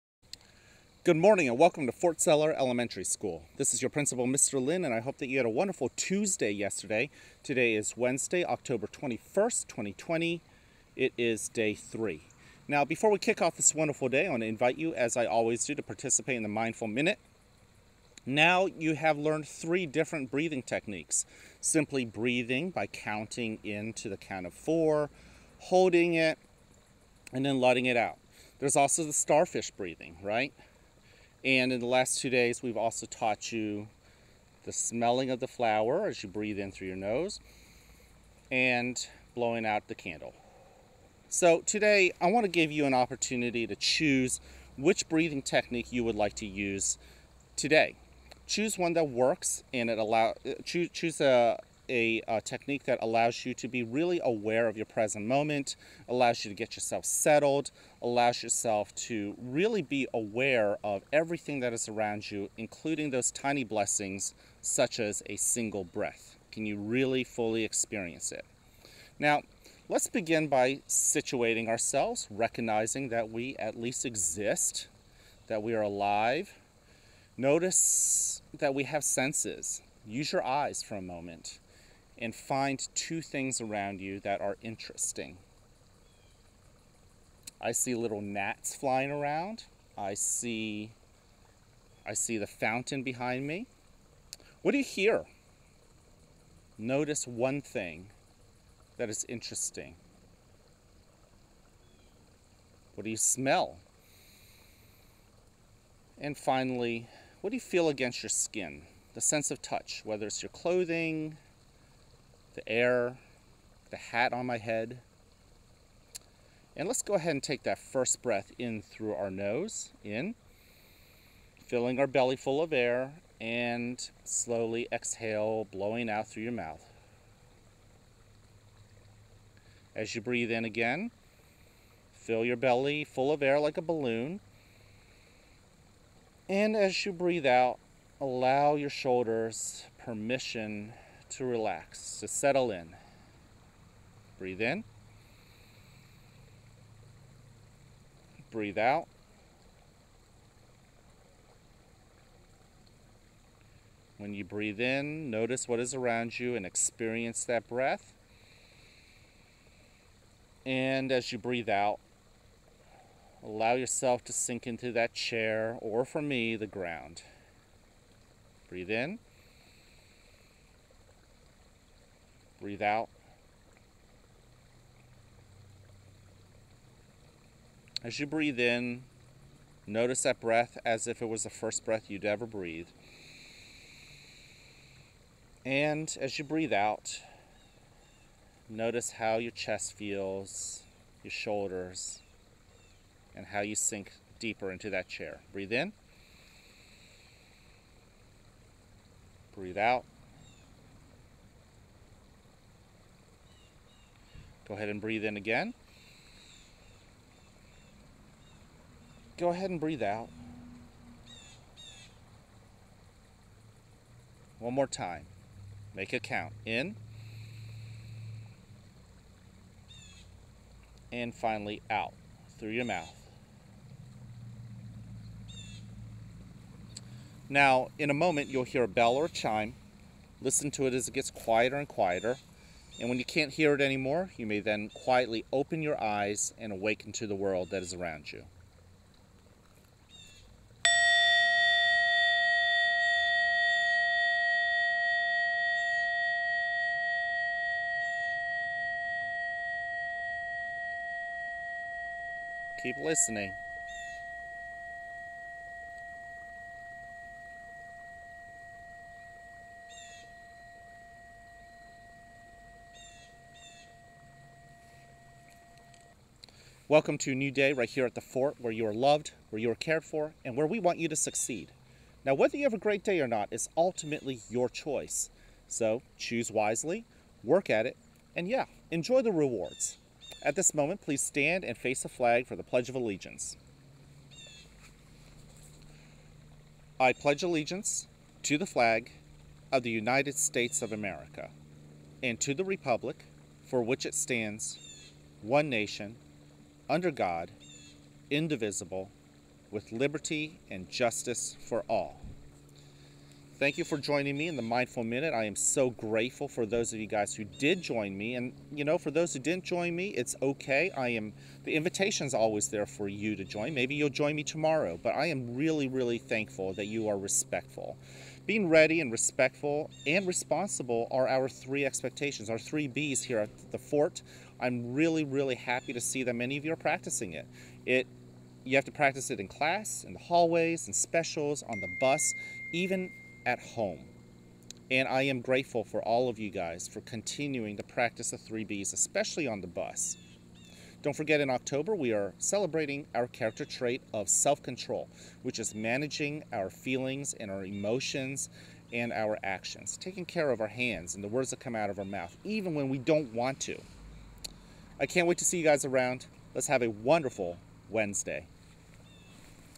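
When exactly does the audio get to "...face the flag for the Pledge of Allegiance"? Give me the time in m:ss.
4:41.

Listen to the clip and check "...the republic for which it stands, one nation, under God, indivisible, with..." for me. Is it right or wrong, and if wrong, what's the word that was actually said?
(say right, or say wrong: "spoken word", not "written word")
right.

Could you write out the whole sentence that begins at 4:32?
Now, whether you have a great day or not is ultimately your choice.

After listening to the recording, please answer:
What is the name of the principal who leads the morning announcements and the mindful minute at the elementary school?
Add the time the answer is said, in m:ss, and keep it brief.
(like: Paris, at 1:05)
Mr. Lynn, at 0:04.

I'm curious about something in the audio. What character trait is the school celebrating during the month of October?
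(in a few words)
self control.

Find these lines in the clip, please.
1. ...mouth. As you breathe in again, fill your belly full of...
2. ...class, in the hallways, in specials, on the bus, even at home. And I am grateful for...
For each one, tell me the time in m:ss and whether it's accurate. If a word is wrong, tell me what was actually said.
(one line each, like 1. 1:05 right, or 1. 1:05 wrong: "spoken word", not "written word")
1. 2:06 right
2. 5:29 right.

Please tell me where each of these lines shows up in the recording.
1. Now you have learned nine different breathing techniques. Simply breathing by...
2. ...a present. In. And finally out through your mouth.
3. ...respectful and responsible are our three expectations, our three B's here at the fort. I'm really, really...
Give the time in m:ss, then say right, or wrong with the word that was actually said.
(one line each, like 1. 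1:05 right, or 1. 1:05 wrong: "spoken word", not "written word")
1. 0:18 wrong: "three", not "nine"
2. 3:36 wrong: "count", not "present"
3. 5:19 right.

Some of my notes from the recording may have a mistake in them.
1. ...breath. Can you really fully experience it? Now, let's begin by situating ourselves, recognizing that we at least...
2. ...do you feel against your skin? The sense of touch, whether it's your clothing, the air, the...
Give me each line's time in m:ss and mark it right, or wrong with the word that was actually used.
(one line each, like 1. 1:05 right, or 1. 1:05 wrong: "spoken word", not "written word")
1. 1:05 right
2. 1:47 right.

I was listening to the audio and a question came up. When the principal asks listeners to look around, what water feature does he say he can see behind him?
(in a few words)
the fountain.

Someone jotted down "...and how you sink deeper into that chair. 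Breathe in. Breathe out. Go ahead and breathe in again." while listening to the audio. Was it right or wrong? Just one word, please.
right.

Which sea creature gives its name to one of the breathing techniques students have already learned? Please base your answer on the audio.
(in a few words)
starfish.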